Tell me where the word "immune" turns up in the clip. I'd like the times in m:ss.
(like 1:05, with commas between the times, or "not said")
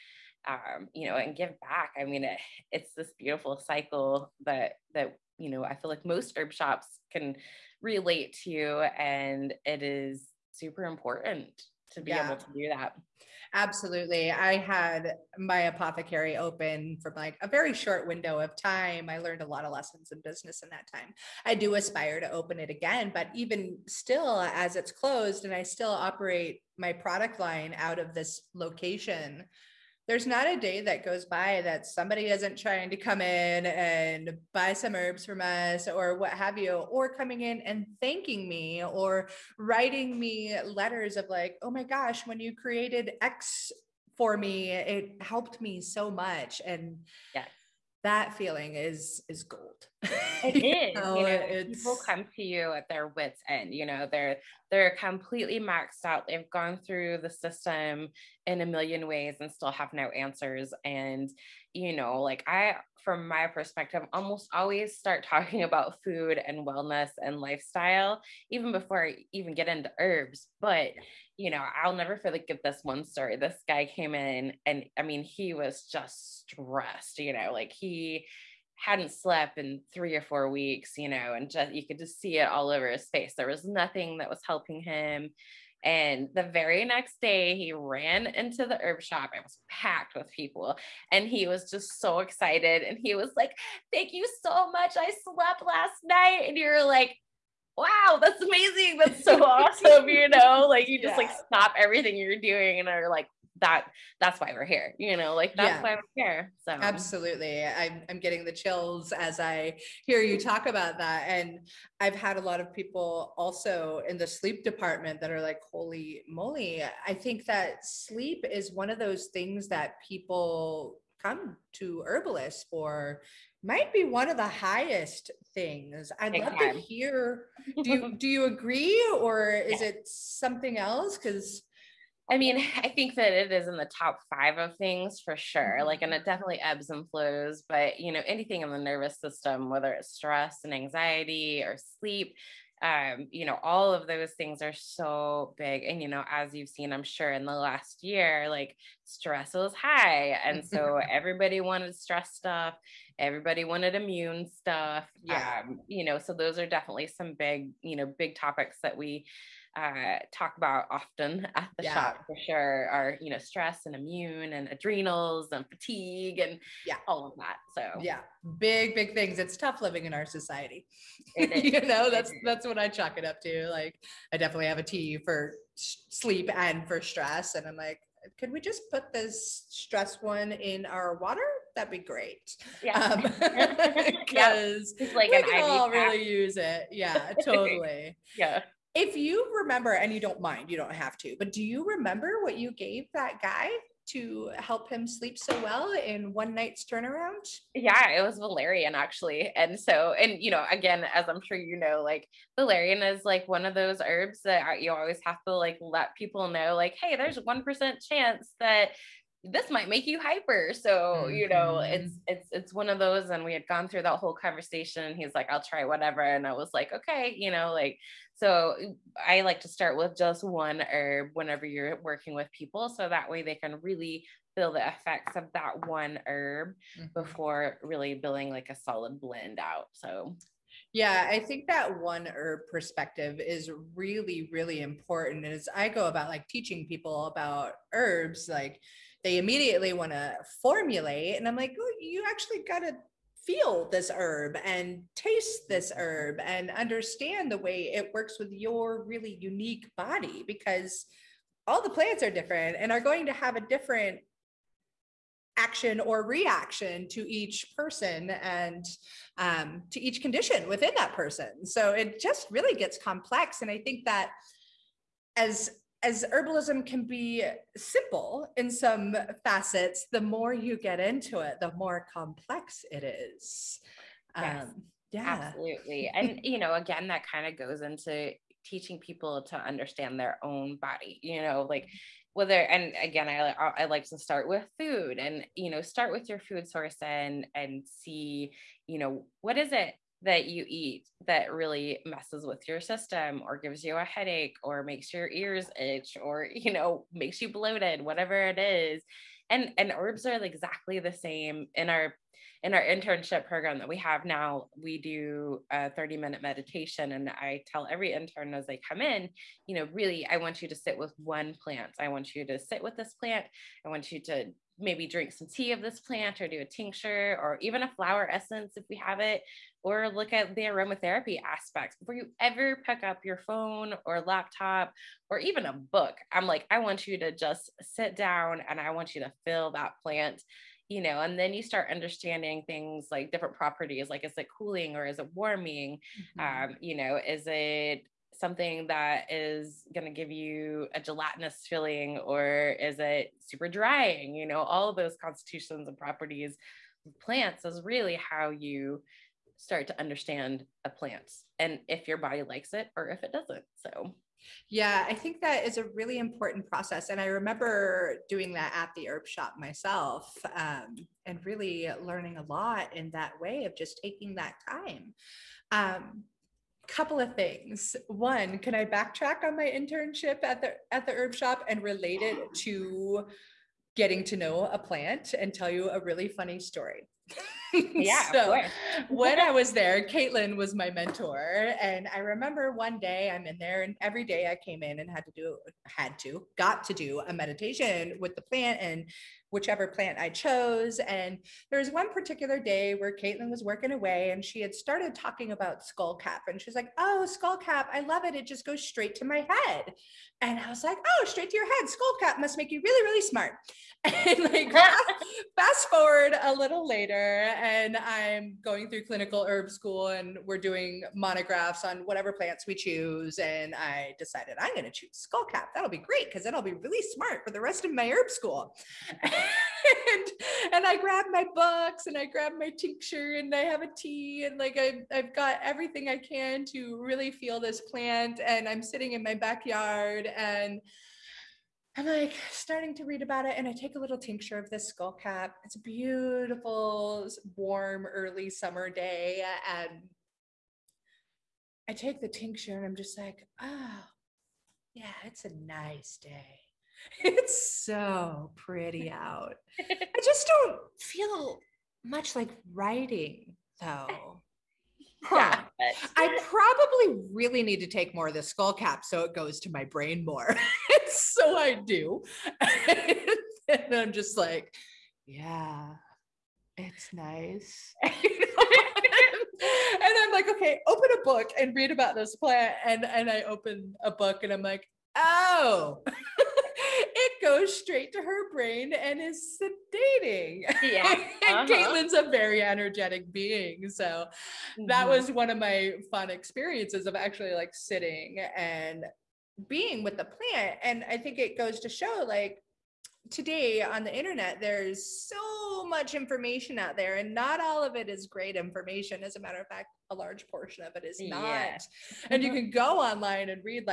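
2:33, 2:43.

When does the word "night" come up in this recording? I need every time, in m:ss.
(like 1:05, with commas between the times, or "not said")
1:36, 3:16.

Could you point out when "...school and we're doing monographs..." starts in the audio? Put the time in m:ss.
6:49.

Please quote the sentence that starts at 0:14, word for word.
I had my apothecary open from like a very short window of time.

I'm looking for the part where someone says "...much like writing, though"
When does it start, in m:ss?
7:32.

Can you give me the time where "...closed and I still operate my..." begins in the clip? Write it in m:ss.
0:24.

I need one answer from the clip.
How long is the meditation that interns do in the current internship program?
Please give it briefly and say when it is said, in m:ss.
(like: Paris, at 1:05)
30 minutes, at 5:05.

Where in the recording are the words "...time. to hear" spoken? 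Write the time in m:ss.
2:06.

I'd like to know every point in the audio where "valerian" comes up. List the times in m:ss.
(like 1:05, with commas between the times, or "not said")
3:18, 3:22.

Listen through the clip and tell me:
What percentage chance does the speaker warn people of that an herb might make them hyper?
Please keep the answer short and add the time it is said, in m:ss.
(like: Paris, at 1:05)
1%, at 3:27.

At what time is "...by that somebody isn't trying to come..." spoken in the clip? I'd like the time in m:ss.
0:31.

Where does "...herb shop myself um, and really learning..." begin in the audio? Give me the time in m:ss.
5:59.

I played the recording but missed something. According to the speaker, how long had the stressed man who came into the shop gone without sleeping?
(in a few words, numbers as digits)
three or four weeks.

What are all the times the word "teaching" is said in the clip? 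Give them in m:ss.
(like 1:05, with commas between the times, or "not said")
3:56, 4:38.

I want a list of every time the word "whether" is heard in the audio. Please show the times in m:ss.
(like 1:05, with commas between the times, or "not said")
2:19, 4:42.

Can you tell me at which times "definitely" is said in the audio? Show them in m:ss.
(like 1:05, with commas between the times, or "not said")
2:16, 2:36, 2:54.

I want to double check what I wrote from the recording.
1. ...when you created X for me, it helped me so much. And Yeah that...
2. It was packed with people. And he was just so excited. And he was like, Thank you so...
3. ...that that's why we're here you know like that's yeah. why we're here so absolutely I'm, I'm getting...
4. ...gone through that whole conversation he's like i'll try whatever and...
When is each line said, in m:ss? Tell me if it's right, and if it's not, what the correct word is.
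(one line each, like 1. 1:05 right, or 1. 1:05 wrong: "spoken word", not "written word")
1. 0:42 right
2. 1:29 right
3. 1:43 right
4. 3:33 right.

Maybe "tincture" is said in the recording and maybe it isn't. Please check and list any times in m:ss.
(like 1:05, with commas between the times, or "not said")
5:16, 7:02, 7:14, 7:22.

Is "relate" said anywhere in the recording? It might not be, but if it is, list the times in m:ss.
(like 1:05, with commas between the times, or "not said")
0:07, 6:11.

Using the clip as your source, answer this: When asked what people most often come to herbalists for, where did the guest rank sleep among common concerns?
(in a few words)
top five.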